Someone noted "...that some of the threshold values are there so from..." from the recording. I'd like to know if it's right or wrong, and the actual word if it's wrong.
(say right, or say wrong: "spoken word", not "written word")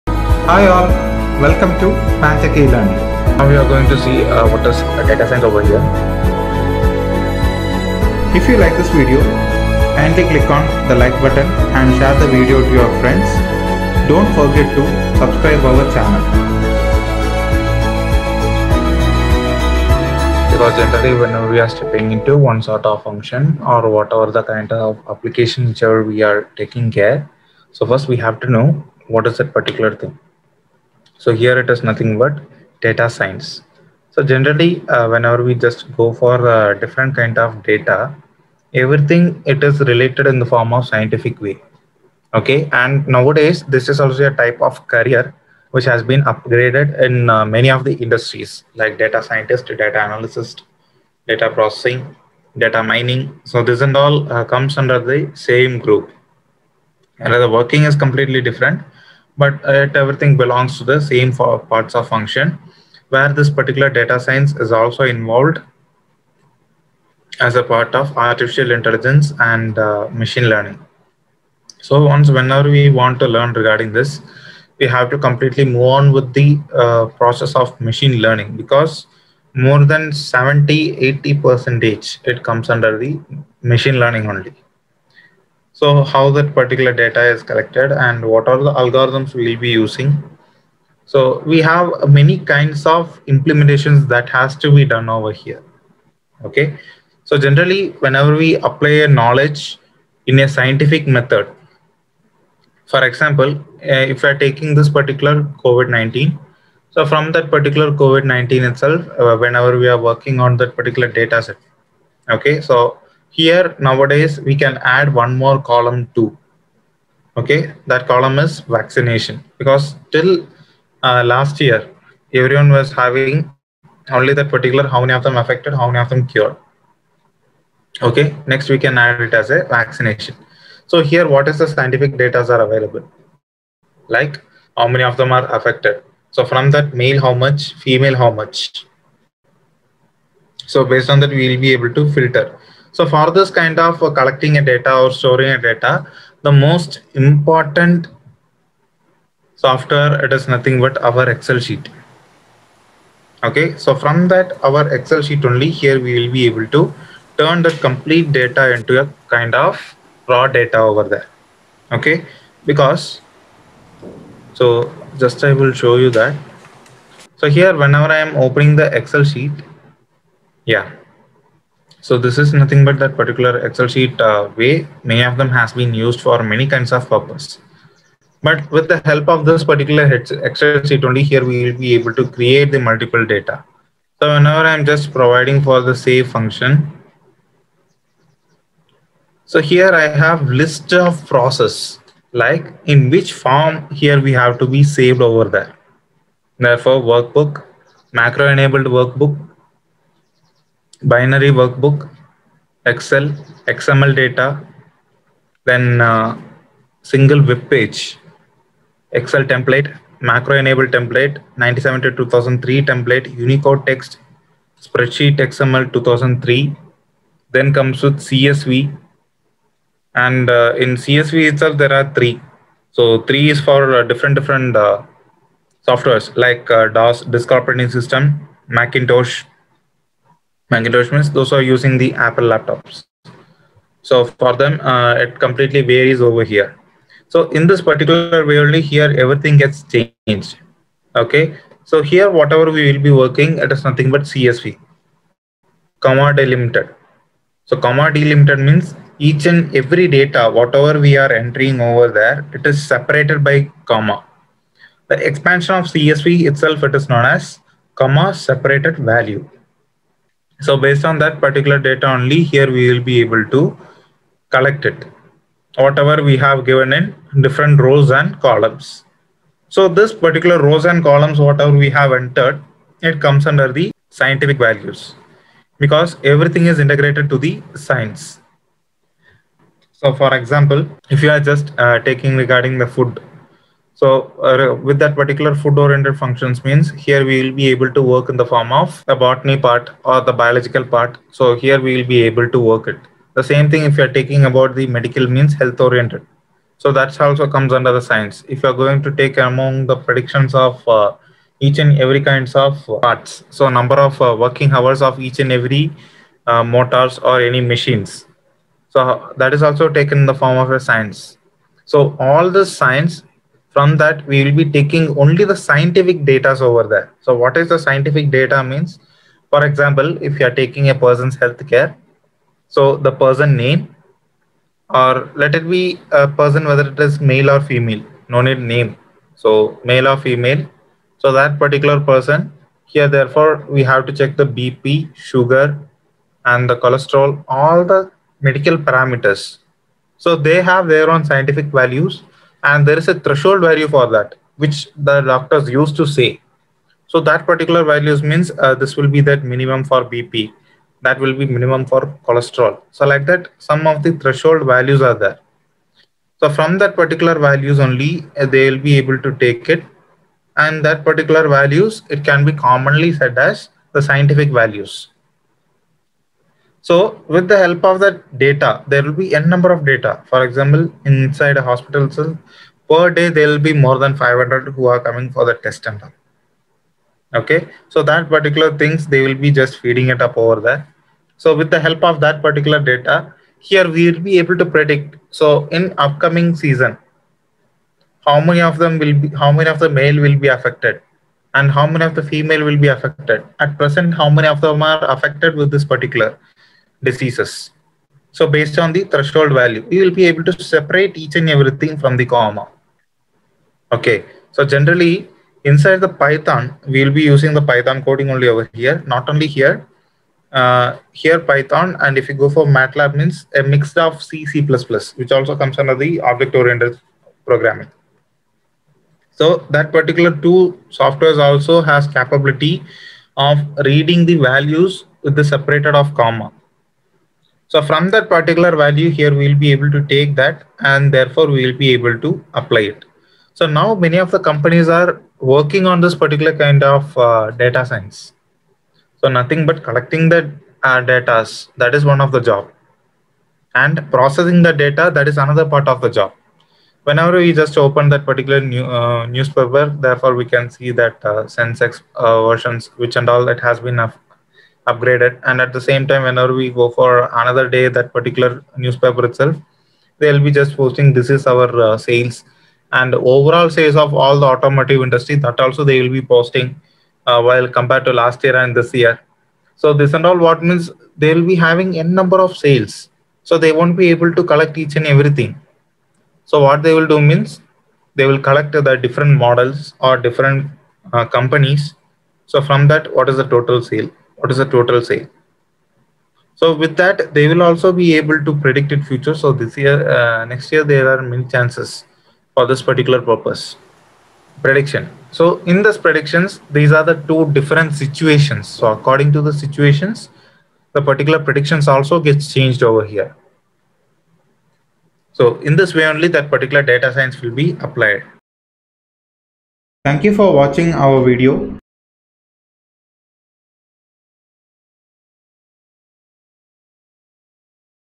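right.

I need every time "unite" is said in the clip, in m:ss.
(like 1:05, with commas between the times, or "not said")
not said.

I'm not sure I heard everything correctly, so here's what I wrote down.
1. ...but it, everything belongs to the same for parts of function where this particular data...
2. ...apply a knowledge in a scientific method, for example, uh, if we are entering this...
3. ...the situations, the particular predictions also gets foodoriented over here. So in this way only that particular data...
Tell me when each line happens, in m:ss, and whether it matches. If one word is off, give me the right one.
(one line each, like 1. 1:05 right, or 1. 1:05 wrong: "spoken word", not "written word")
1. 0:59 right
2. 1:38 wrong: "taking", not "entering"
3. 8:19 wrong: "changed", not "foodoriented".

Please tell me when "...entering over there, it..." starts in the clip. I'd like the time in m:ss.
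4:11.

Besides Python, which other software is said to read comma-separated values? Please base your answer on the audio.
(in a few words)
MATLAB.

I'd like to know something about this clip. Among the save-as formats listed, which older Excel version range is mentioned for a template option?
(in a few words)
97 to 2003.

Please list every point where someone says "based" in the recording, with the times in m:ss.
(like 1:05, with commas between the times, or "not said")
2:20, 4:20, 6:38.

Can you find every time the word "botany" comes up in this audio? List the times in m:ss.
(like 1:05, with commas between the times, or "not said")
4:49.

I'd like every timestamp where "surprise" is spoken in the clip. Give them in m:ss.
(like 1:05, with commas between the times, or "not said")
not said.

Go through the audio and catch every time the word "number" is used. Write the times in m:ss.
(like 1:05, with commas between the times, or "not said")
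5:03, 6:09, 7:52.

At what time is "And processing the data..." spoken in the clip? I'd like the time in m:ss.
7:23.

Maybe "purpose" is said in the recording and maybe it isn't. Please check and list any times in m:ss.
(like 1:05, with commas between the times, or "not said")
2:57, 8:13.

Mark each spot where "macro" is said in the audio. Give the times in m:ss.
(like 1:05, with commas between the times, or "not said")
3:18, 3:30.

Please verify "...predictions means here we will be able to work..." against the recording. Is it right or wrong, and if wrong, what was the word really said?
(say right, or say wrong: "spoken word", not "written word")
wrong: "functions", not "predictions".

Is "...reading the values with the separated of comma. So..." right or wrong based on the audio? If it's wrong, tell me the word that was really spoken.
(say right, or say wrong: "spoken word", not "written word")
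right.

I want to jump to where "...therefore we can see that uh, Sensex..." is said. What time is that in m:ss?
7:30.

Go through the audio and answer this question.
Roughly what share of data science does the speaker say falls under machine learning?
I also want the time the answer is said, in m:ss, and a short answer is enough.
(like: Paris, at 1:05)
70 to 80 percent, at 1:20.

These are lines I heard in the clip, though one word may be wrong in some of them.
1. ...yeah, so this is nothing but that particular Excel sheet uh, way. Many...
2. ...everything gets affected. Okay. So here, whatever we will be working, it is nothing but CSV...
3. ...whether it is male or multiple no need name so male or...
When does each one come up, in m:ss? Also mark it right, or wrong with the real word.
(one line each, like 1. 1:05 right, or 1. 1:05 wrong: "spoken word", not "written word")
1. 2:50 right
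2. 3:59 wrong: "changed", not "affected"
3. 5:26 wrong: "female", not "multiple".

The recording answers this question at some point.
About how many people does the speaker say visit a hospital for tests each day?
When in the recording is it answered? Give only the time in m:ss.
6:14.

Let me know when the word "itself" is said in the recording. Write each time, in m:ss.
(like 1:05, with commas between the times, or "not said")
1:48, 3:41, 4:16, 7:39.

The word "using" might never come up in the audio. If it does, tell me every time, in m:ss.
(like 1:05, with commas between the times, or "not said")
1:29, 3:51, 6:47.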